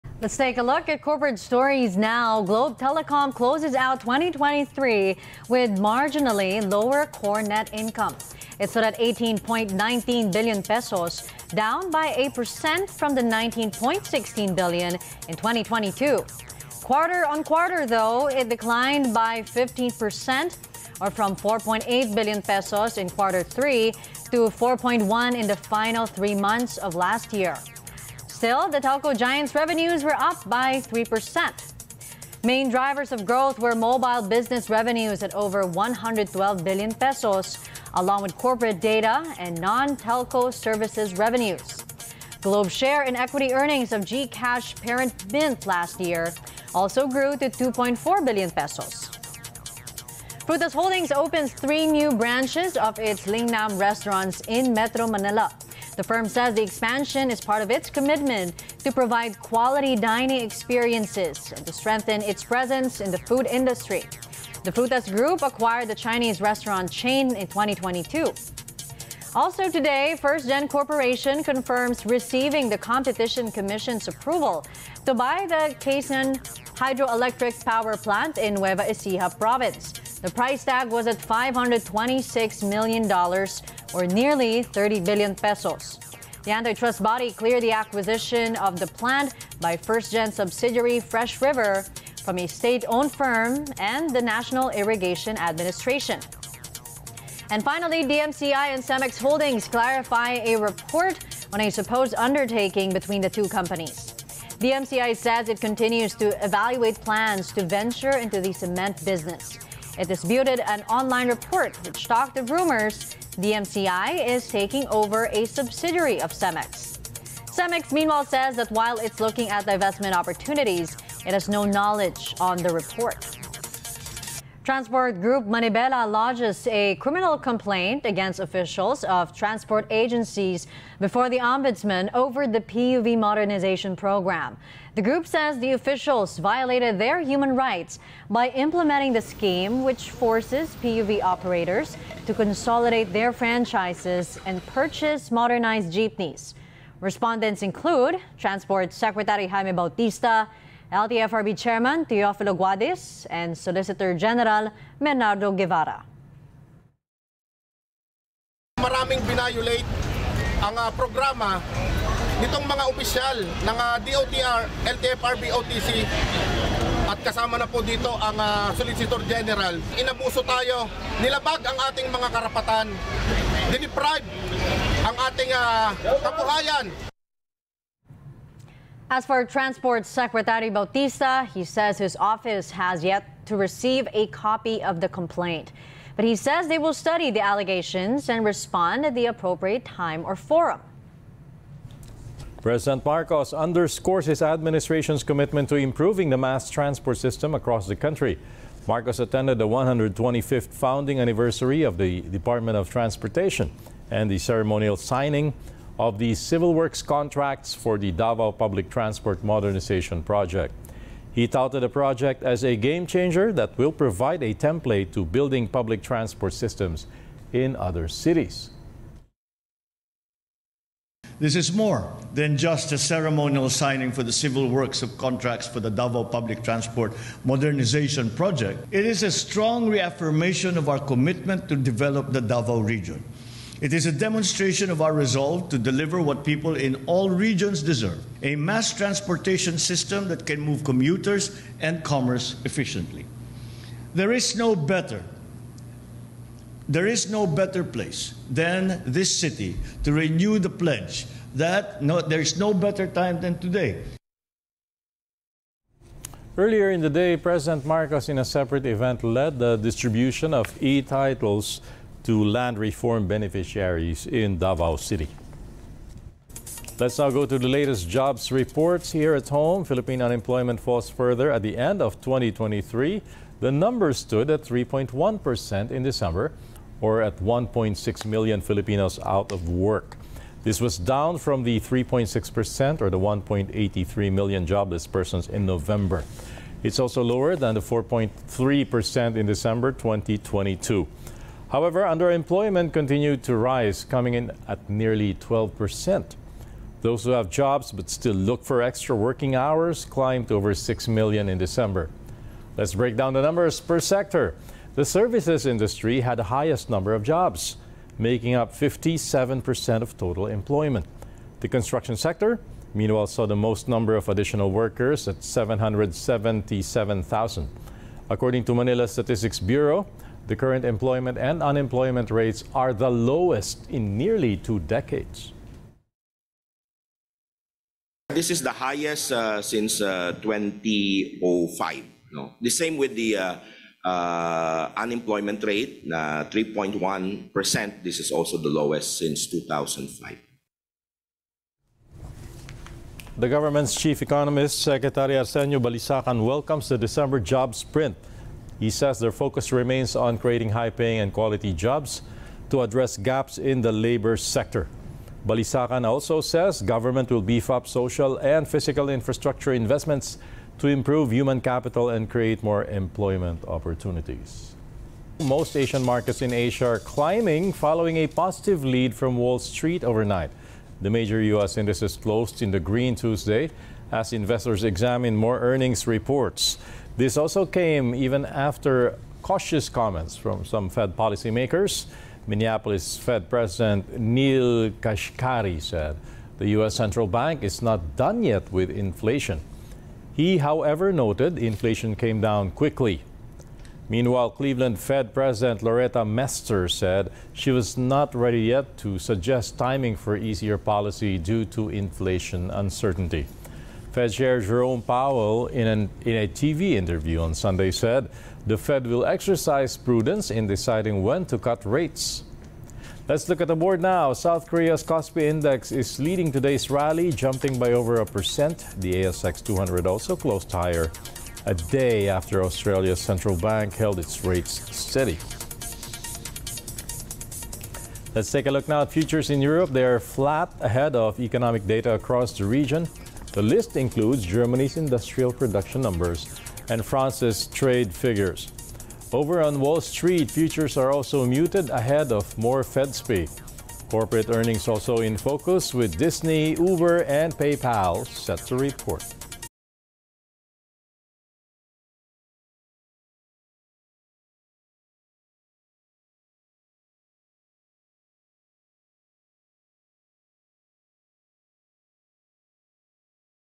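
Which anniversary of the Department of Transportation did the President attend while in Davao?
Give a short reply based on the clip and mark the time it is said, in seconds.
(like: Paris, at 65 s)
125th, at 199 s.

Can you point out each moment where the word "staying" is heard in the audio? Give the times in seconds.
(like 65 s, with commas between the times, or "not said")
not said.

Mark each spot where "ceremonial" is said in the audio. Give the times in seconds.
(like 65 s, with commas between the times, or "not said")
204 s, 222 s.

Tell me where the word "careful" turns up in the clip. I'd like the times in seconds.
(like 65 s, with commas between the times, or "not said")
not said.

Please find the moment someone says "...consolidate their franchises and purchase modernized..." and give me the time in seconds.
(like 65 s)
142 s.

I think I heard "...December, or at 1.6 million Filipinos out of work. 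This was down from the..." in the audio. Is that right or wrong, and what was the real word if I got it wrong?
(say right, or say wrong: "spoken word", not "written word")
right.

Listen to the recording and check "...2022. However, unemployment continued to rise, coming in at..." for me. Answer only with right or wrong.
wrong.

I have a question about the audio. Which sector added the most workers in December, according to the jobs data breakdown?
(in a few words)
Construction.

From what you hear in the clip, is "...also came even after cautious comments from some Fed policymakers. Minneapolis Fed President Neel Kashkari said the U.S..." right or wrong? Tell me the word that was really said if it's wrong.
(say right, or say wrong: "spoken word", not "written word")
right.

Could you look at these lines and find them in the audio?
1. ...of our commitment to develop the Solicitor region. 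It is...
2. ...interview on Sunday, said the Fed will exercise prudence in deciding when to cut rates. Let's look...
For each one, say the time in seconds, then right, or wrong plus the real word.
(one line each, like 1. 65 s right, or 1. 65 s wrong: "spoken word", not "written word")
1. 230 s wrong: "Davao", not "Solicitor"
2. 406 s right.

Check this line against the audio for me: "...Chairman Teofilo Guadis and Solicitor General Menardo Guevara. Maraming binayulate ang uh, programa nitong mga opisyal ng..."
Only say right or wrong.
right.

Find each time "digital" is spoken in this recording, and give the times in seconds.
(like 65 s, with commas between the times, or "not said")
not said.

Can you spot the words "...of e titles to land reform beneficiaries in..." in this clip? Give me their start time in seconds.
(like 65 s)
260 s.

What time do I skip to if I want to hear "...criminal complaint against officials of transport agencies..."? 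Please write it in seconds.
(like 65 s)
126 s.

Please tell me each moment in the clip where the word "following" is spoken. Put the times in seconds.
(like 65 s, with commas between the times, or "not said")
367 s.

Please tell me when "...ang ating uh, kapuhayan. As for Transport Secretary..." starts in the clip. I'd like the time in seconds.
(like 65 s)
175 s.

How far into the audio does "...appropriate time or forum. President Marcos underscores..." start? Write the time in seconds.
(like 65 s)
189 s.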